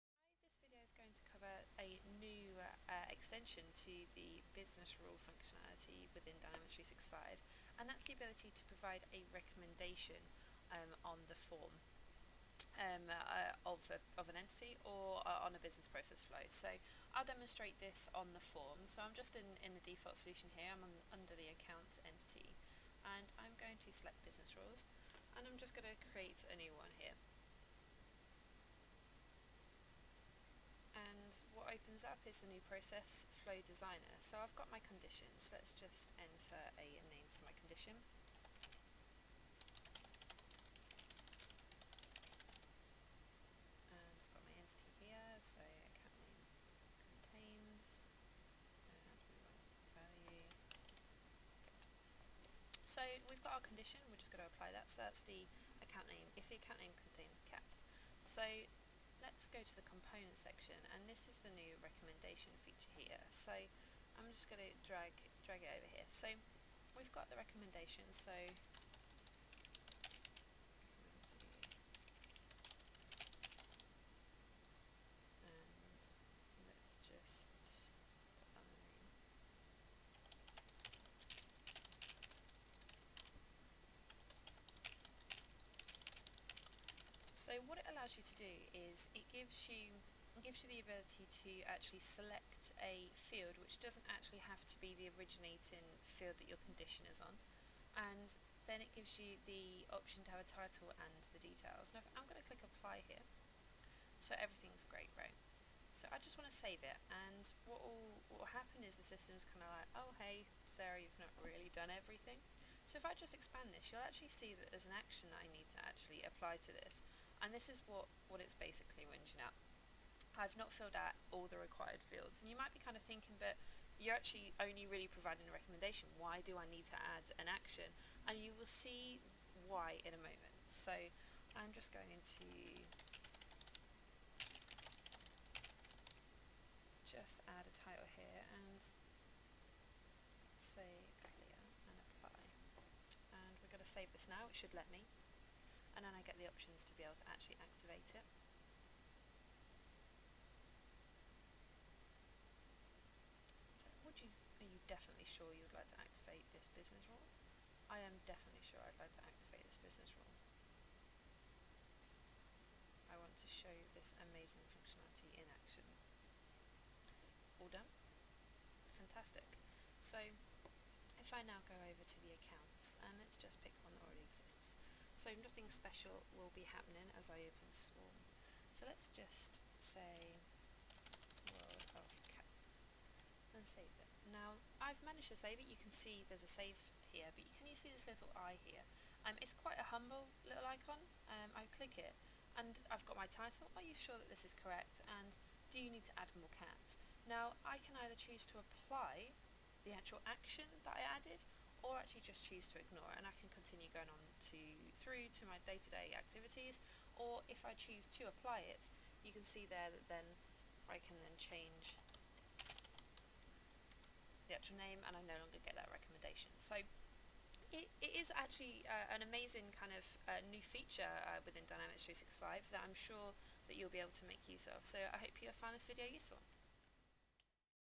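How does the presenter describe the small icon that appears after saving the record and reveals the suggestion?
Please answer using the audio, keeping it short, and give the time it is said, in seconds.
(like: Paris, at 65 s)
humble little icon, at 189 s.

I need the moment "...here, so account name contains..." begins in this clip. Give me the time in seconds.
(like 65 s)
44 s.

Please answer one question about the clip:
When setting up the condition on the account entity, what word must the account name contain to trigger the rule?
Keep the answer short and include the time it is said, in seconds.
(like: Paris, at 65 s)
cat, at 57 s.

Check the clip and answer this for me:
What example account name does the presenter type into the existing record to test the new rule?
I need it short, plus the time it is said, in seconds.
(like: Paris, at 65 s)
World of cats, at 181 s.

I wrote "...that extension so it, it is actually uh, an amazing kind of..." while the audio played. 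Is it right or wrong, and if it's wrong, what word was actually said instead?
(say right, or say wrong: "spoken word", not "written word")
wrong: "recommendation", not "extension".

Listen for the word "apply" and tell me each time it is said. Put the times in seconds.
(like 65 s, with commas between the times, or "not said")
54 s, 102 s, 116 s, 142 s, 198 s, 208 s.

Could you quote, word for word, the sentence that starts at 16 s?
So I'll demonstrate this on the form.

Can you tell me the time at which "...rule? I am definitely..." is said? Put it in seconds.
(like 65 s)
157 s.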